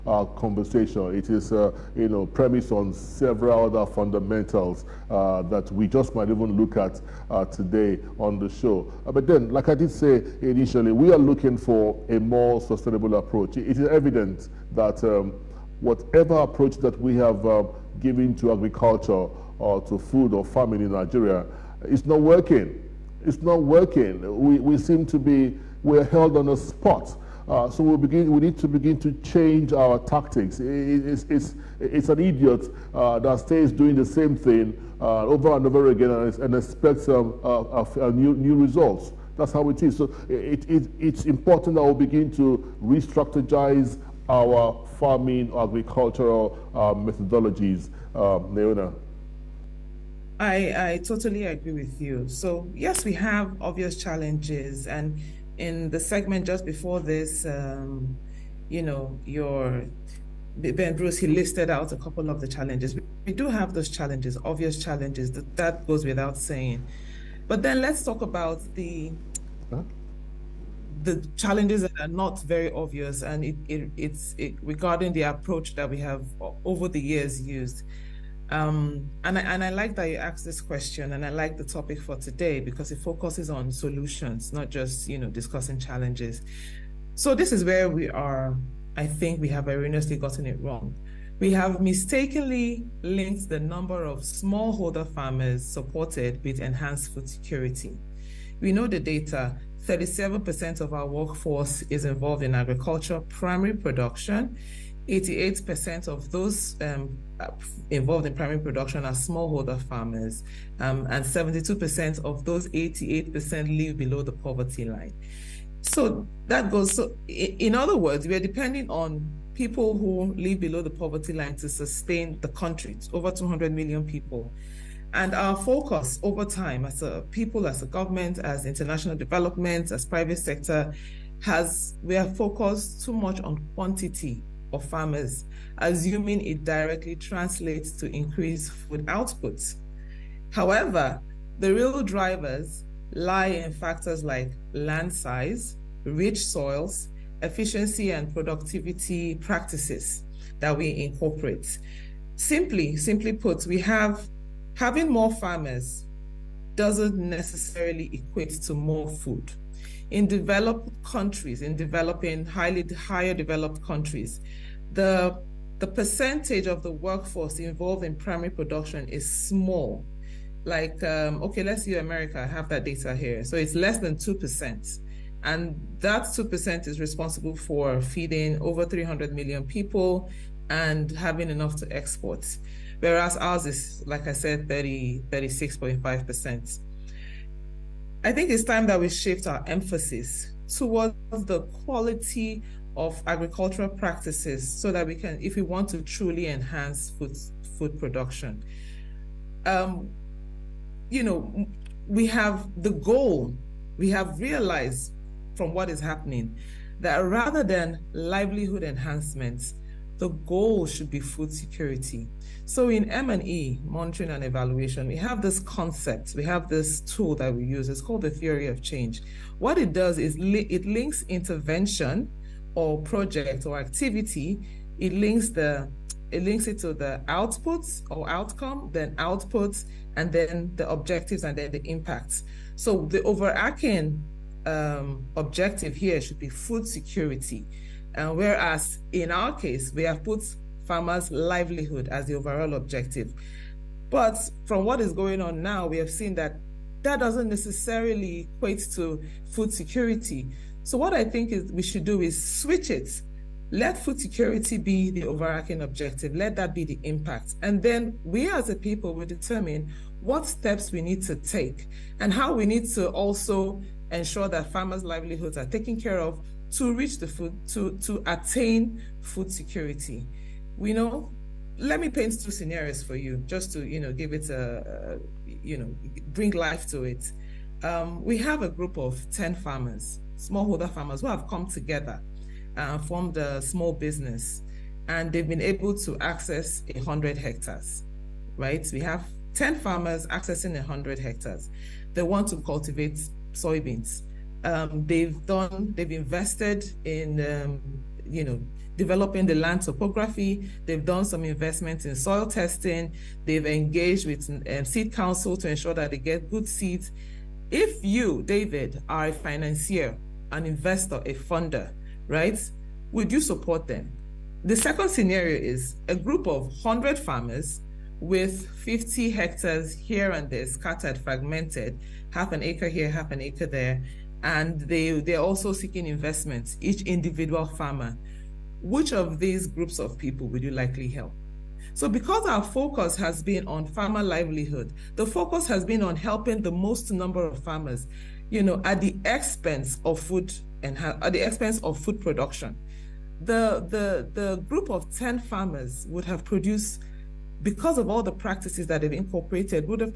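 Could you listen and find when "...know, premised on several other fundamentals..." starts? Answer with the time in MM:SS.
00:02.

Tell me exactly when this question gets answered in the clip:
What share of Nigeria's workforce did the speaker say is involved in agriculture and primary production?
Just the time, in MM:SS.
01:39.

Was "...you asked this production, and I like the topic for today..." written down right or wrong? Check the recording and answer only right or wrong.
wrong.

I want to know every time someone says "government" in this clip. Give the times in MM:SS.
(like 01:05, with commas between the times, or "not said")
02:07.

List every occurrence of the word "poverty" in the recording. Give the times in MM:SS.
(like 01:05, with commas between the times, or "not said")
01:54, 02:00.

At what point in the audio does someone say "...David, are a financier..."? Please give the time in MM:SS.
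05:08.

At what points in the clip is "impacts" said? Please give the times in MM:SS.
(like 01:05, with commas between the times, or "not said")
03:51, 04:17.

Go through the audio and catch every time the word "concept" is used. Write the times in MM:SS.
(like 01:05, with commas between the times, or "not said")
03:35.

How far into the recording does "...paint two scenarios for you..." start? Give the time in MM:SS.
04:32.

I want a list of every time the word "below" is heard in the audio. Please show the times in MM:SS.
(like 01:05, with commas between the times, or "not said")
01:53, 02:00.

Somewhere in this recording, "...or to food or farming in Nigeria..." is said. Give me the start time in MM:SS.
00:19.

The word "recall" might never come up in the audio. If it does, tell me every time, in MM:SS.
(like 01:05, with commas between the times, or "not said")
not said.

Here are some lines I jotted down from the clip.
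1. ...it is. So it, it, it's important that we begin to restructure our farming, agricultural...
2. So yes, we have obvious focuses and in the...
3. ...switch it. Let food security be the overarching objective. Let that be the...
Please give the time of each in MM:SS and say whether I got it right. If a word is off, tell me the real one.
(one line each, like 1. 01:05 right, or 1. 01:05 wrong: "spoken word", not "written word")
1. 00:39 right
2. 00:52 wrong: "challenges", not "focuses"
3. 04:12 right.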